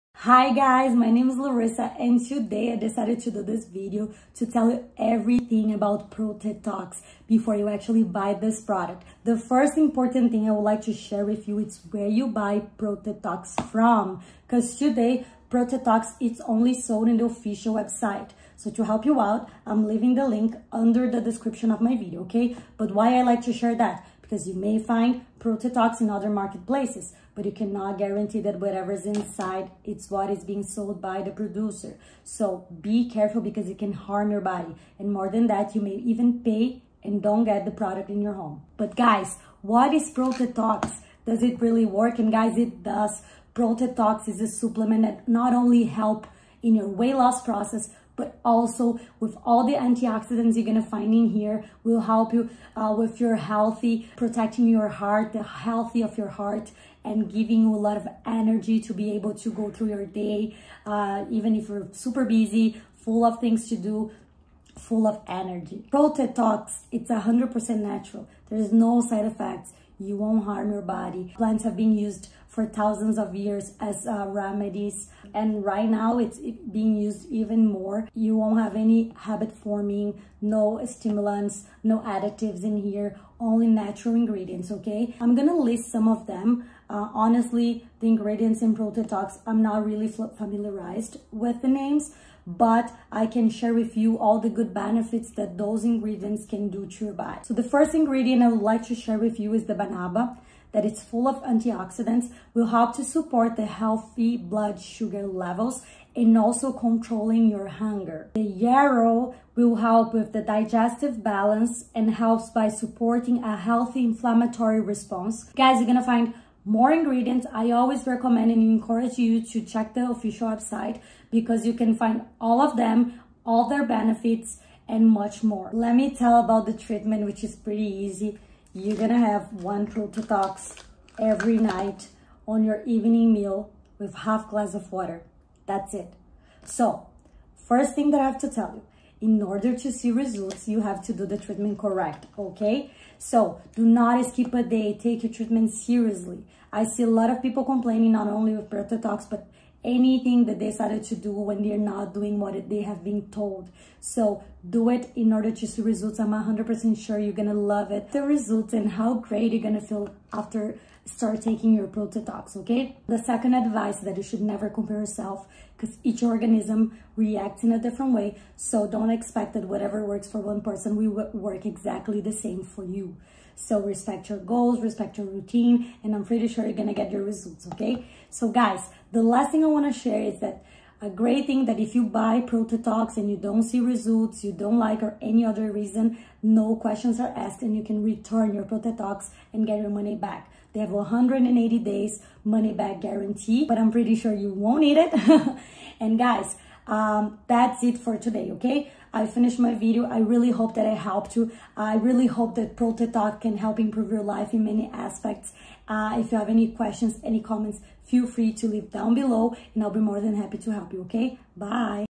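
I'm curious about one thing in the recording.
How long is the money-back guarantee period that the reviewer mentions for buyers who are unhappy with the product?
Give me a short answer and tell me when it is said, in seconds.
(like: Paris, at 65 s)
180 days, at 190 s.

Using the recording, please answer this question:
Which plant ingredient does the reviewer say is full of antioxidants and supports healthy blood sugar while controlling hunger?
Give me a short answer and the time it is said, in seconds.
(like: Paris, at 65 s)
Banaba, at 99 s.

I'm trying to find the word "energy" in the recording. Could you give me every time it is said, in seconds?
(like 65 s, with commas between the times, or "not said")
58 s, 65 s.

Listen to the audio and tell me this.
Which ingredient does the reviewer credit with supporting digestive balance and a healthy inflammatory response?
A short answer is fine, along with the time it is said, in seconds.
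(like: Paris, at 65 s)
Yarrow, at 108 s.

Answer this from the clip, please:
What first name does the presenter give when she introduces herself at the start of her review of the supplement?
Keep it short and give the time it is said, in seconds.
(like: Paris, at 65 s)
Larissa, at 1 s.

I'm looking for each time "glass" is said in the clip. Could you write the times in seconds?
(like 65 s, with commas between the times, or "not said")
134 s.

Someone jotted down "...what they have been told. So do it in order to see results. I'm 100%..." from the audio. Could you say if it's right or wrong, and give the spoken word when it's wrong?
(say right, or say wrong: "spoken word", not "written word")
right.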